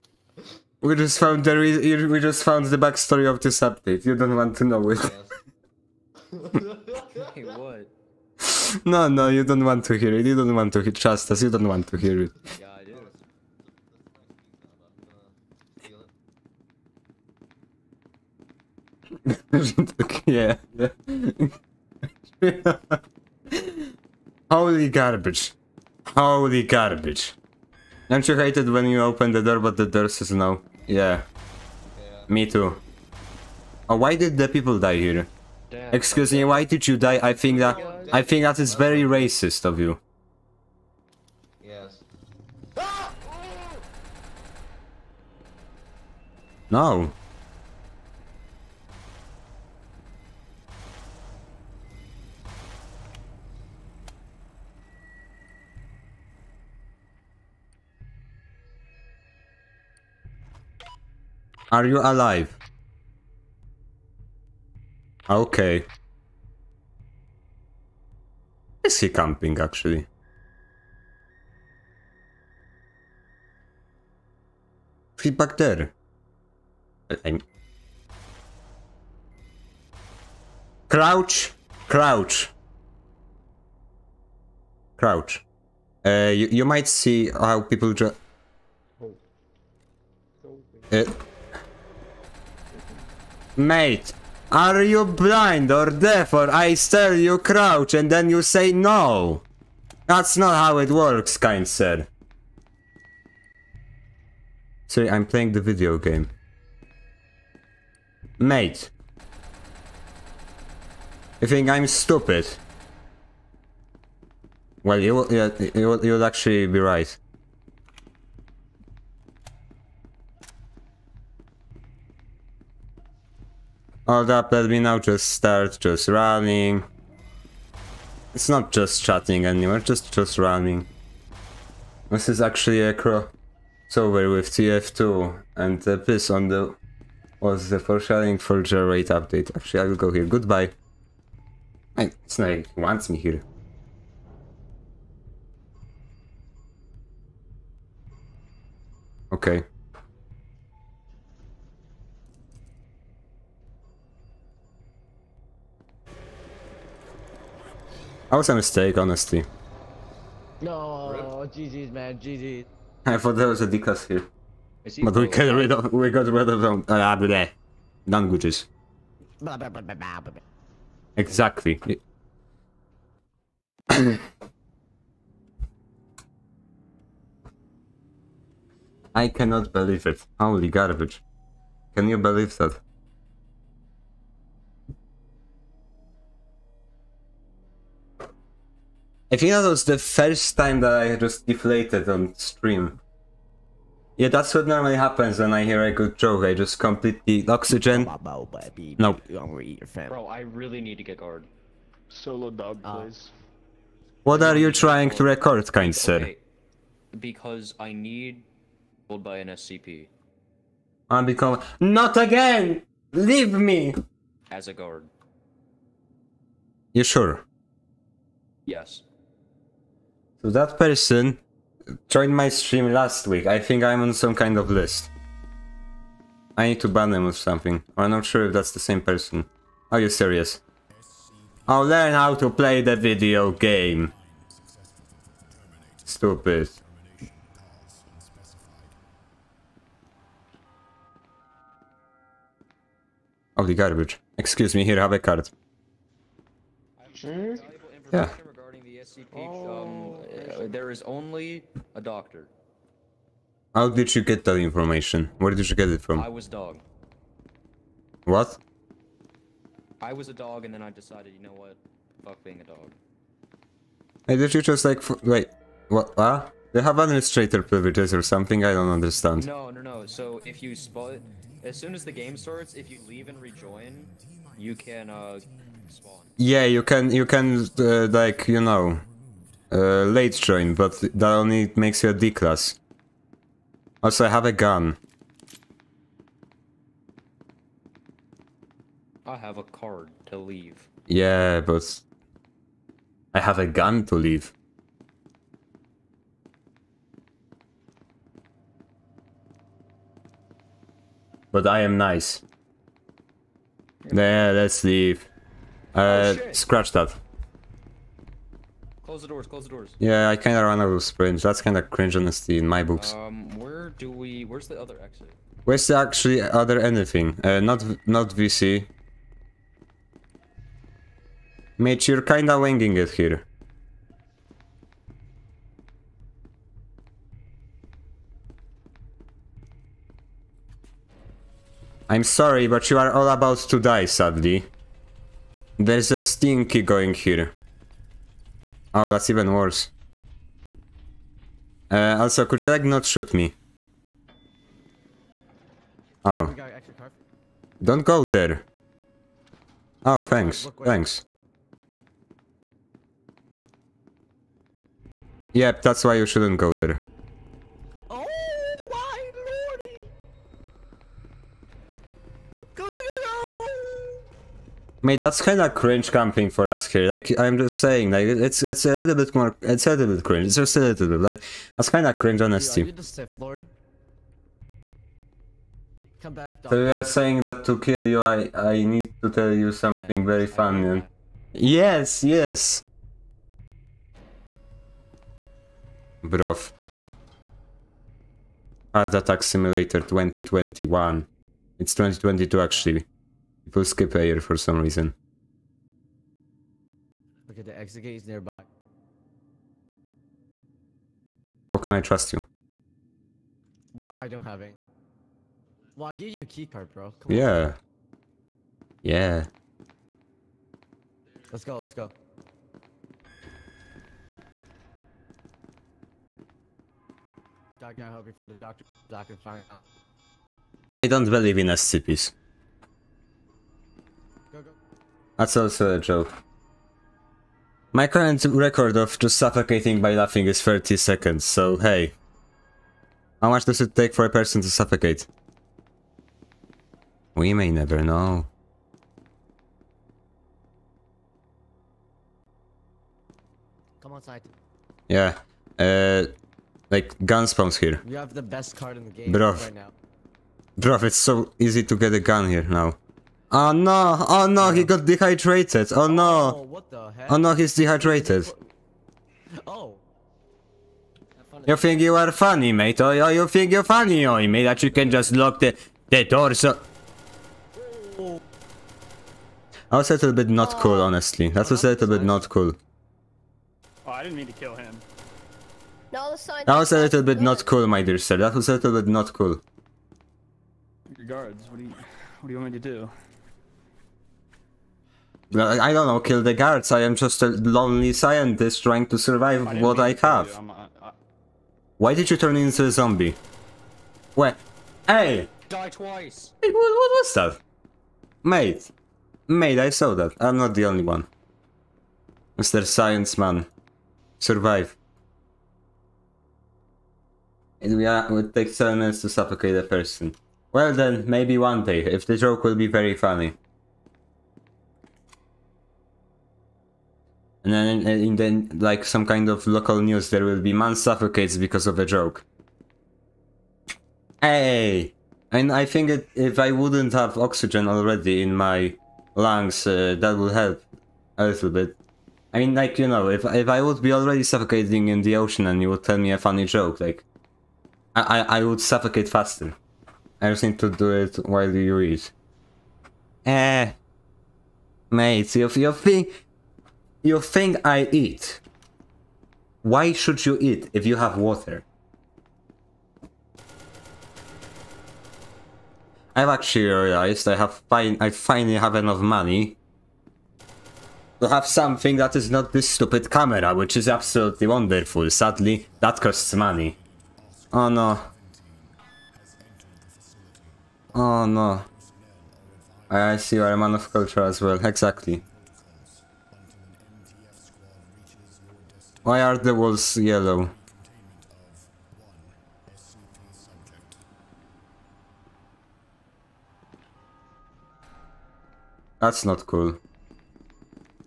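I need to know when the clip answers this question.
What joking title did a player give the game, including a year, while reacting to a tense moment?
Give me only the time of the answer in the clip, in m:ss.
6:28.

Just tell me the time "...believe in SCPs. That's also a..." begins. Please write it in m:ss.
7:01.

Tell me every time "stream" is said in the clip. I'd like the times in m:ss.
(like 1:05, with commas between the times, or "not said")
3:12, 3:42.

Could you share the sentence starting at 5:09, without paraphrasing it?
Yeah, I kinda ran out of springs.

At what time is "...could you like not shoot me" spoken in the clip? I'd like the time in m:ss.
5:42.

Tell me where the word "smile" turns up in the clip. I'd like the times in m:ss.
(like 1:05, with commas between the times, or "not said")
not said.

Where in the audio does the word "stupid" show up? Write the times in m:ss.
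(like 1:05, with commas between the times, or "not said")
1:51, 3:56, 9:22.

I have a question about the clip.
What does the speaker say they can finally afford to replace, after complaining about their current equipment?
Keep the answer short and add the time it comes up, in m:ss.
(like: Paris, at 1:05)
Camera, at 9:22.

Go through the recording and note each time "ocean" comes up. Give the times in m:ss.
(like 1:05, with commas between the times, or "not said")
8:55.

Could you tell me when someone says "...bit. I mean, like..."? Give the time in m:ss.
8:51.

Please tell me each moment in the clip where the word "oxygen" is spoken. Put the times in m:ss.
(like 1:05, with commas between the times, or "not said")
3:17, 8:47.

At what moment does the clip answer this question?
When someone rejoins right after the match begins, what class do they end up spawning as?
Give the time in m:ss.
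4:42.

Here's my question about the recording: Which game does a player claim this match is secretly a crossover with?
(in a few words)
TF2.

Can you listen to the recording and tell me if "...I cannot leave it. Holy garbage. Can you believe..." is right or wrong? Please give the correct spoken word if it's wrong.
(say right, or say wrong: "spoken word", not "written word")
wrong: "believe", not "leave".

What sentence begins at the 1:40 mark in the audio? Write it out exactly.
That's not how it works, kind said.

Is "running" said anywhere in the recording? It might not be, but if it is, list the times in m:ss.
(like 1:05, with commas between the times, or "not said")
2:06, 2:10.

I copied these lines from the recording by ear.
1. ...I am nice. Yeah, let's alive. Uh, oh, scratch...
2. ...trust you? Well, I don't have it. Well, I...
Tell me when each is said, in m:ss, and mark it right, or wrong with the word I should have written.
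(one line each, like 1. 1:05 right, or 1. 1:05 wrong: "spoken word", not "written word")
1. 5:01 wrong: "leave", not "alive"
2. 6:41 right.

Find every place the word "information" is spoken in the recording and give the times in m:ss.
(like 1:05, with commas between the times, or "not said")
4:14.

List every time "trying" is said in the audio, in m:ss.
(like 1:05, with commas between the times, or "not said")
3:24, 8:08.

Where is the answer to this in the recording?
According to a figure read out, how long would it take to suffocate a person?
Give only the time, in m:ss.
8:28.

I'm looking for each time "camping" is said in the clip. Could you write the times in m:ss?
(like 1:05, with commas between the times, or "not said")
1:09, 6:06.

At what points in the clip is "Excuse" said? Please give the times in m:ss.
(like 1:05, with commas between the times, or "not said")
0:35, 4:04.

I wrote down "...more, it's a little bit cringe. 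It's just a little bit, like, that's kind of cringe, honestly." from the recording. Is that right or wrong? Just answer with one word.
right.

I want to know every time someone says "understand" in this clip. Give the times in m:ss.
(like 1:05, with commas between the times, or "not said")
4:28.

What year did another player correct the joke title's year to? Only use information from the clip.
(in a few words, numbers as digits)
2022.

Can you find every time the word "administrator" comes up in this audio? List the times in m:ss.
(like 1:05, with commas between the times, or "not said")
4:26.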